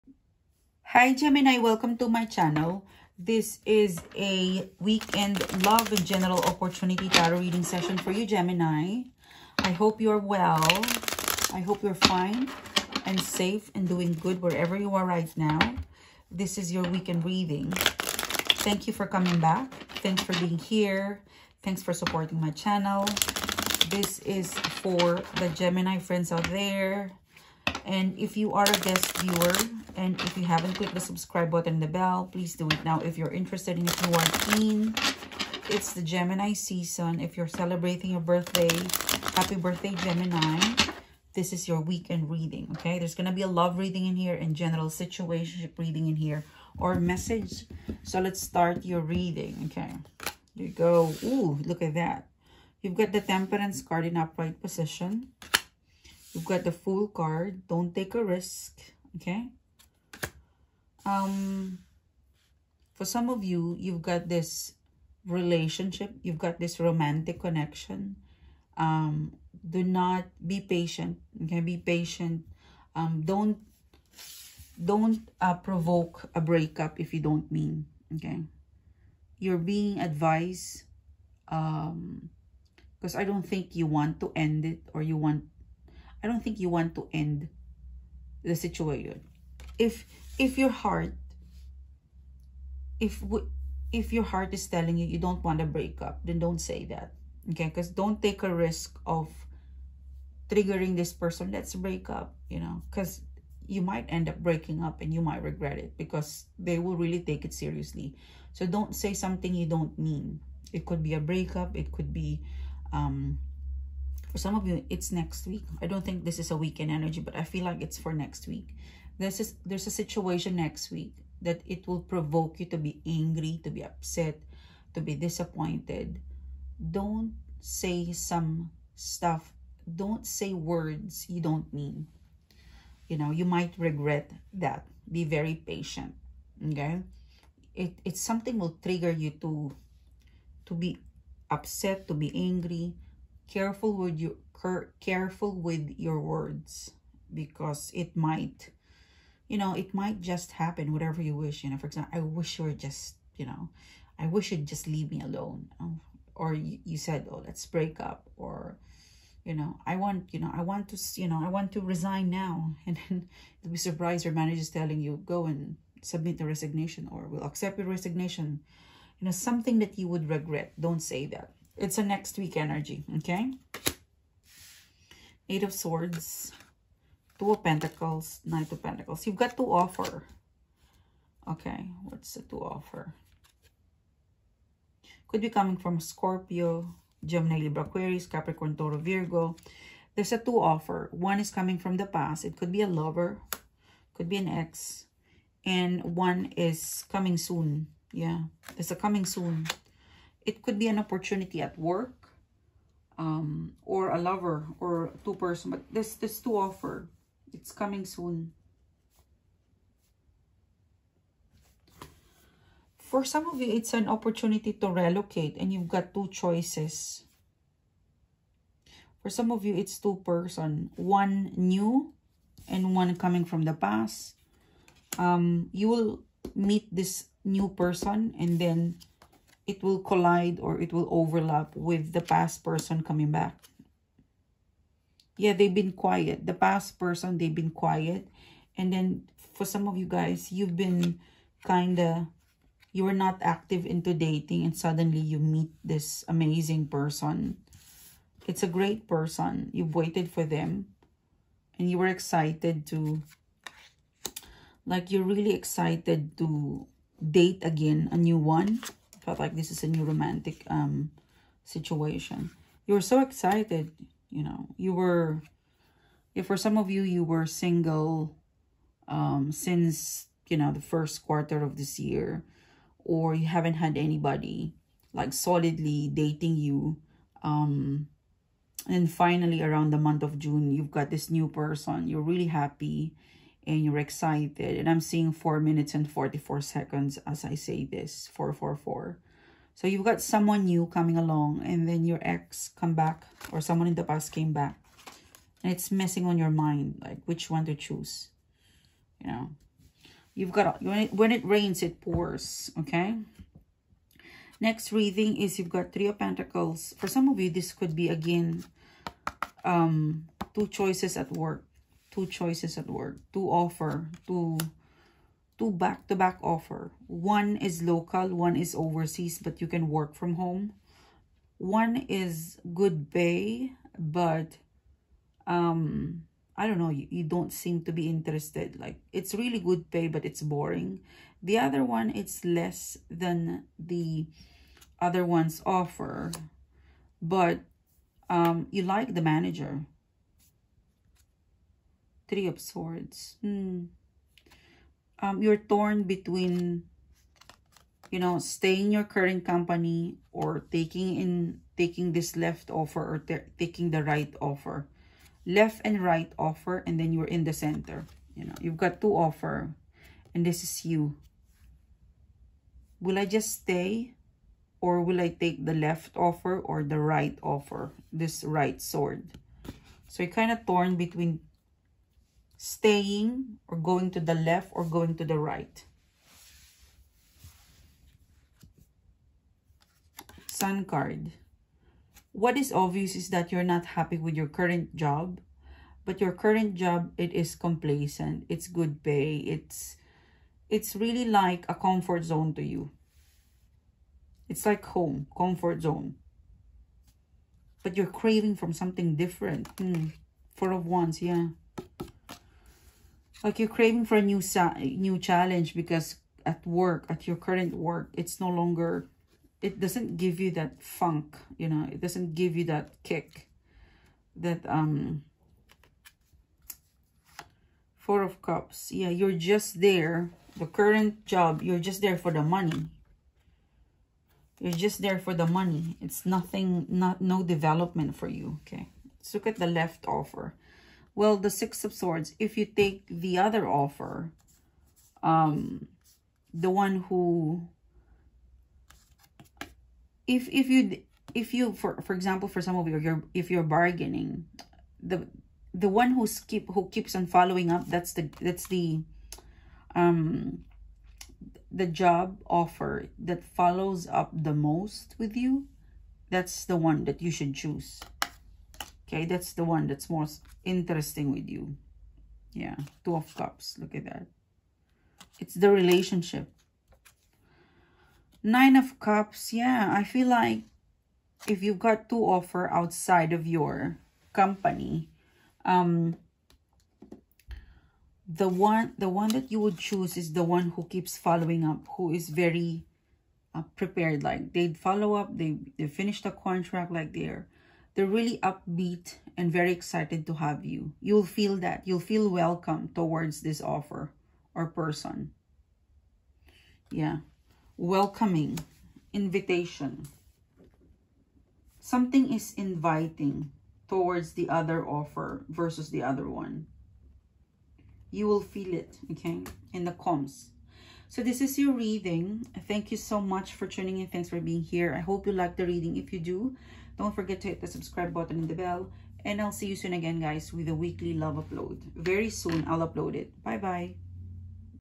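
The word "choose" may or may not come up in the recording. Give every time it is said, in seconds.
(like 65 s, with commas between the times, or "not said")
297 s, 457 s, 479 s.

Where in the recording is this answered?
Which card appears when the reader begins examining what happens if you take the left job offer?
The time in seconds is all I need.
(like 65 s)
431 s.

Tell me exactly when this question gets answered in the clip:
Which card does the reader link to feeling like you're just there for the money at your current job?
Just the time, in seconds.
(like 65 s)
417 s.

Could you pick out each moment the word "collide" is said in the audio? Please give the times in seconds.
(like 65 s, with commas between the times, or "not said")
230 s.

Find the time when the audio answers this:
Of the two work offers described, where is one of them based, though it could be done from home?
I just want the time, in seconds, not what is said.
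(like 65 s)
318 s.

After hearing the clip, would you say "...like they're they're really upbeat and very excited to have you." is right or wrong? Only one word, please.
right.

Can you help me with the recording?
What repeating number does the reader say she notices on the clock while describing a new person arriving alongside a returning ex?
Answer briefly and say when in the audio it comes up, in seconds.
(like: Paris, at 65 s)
444, at 288 s.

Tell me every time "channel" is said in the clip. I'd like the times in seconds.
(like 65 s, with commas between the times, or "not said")
2 s, 22 s.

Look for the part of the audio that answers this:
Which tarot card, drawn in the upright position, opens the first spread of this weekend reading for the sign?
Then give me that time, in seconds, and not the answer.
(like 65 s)
53 s.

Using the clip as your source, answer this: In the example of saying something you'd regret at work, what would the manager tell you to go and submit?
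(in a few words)
The resignation.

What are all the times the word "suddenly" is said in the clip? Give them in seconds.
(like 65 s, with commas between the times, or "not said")
244 s.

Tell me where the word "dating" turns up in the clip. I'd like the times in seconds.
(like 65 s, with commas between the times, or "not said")
244 s, 276 s.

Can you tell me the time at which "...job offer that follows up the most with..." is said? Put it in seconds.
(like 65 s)
451 s.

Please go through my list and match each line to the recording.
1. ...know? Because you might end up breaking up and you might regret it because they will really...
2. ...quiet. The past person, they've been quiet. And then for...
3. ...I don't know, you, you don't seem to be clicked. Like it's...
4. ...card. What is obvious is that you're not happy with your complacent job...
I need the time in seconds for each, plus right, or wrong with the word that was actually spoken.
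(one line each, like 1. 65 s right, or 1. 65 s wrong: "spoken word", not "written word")
1. 102 s right
2. 235 s right
3. 326 s wrong: "interested", not "clicked"
4. 380 s wrong: "current", not "complacent".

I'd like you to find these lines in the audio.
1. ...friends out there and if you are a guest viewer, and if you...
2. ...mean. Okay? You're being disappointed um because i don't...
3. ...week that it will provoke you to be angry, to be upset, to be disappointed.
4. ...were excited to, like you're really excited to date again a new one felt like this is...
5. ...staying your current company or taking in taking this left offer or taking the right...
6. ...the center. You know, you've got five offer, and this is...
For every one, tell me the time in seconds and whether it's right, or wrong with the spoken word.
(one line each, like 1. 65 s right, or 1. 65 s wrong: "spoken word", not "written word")
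1. 25 s right
2. 77 s wrong: "advised", not "disappointed"
3. 120 s right
4. 251 s right
5. 348 s right
6. 357 s wrong: "two", not "five".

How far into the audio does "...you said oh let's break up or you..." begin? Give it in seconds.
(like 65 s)
156 s.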